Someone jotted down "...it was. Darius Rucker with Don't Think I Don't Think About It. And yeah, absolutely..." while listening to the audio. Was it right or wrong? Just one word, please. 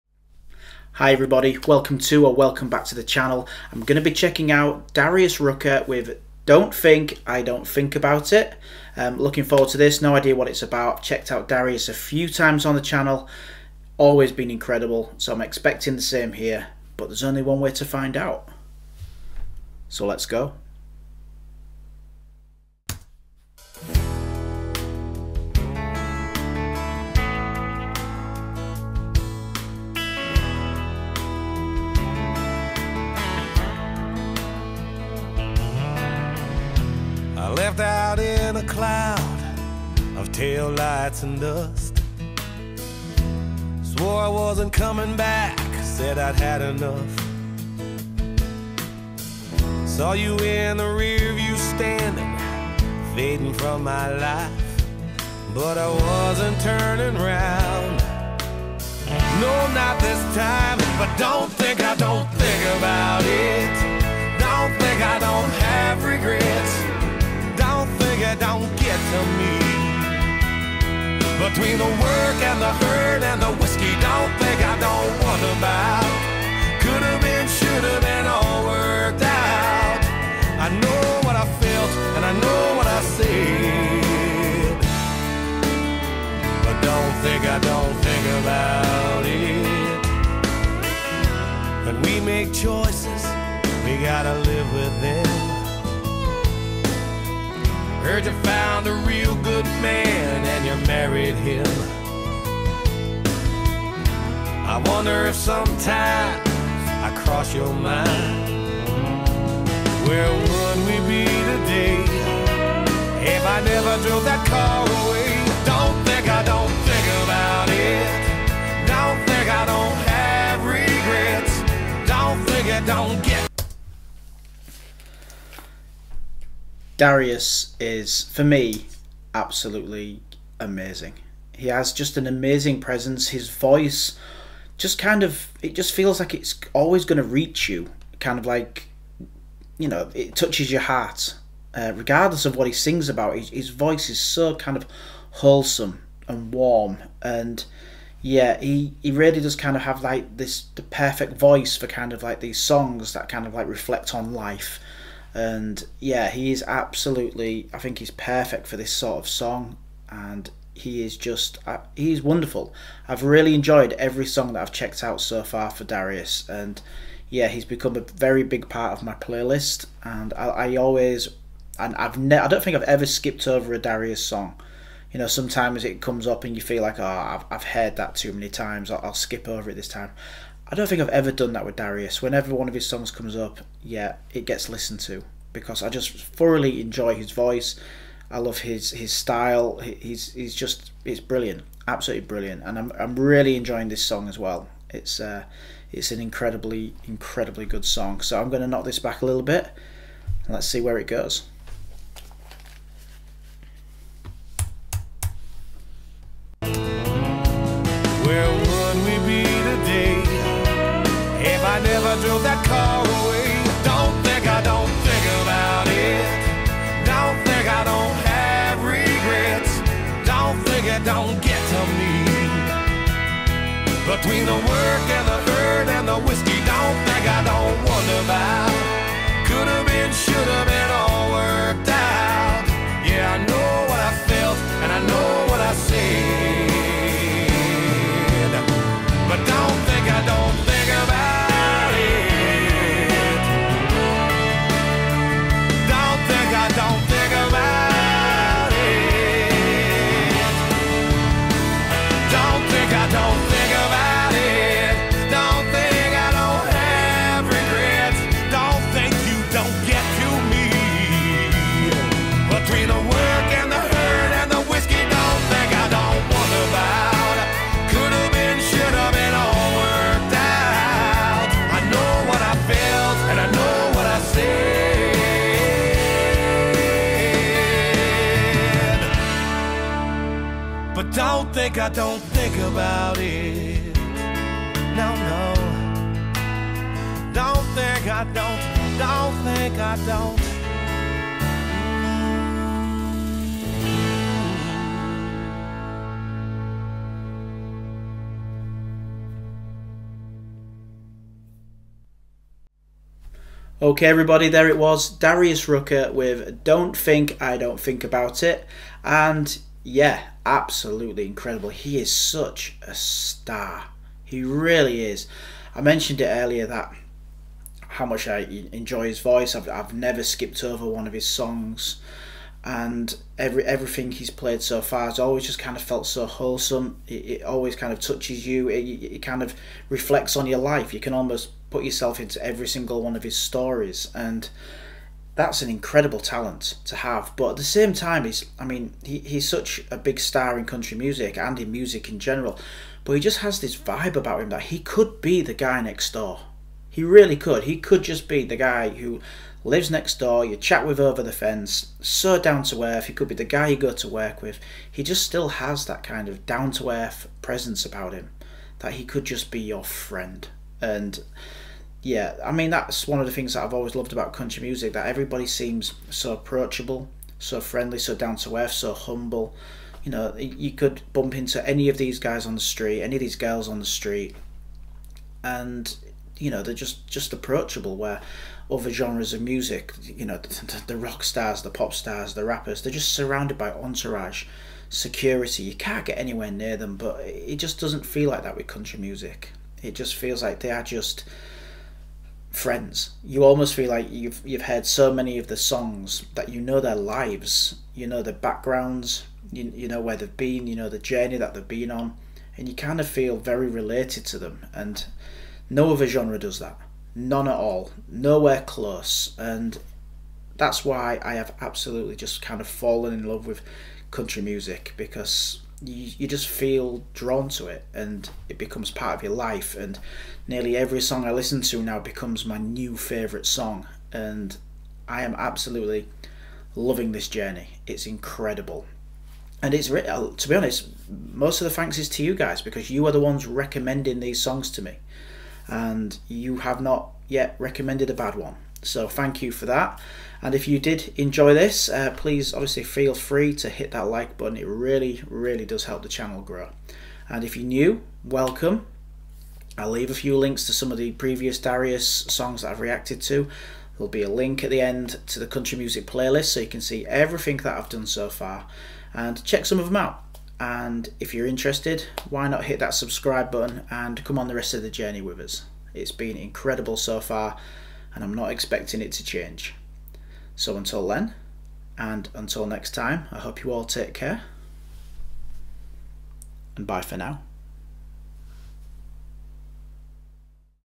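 right.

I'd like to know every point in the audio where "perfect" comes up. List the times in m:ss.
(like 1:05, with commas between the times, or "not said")
2:30, 2:38.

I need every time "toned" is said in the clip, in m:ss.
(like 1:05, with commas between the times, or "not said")
not said.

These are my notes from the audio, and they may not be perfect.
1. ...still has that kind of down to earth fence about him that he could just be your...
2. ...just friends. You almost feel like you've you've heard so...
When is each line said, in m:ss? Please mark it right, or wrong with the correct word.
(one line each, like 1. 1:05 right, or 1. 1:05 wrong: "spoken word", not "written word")
1. 5:55 wrong: "presence", not "fence"
2. 6:30 right.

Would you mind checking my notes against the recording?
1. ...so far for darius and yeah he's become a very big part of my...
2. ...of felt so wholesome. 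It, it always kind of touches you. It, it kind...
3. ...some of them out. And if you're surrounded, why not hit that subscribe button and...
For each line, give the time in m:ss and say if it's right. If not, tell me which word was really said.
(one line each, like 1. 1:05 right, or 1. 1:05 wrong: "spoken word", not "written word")
1. 2:45 right
2. 5:25 right
3. 7:39 wrong: "interested", not "surrounded".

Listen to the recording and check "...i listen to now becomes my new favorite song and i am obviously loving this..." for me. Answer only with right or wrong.
wrong.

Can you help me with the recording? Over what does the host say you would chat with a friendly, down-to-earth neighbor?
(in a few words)
the fence.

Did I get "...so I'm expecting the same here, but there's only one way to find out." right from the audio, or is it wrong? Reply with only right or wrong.
right.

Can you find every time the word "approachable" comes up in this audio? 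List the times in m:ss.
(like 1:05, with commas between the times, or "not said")
6:06, 6:17.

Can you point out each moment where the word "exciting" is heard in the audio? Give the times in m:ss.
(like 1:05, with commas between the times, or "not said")
not said.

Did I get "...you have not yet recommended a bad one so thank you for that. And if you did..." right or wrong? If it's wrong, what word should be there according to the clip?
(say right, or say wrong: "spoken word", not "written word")
right.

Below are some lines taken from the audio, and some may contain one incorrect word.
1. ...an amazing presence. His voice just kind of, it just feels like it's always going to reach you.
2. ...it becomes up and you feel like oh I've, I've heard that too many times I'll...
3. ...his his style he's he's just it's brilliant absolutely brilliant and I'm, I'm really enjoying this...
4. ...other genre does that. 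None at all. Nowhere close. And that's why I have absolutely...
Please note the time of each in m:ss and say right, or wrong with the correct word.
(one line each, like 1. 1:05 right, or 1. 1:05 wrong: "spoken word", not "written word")
1. 2:12 right
2. 2:55 wrong: "comes", not "becomes"
3. 3:08 right
4. 6:45 right.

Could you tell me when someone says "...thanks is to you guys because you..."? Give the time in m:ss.
7:11.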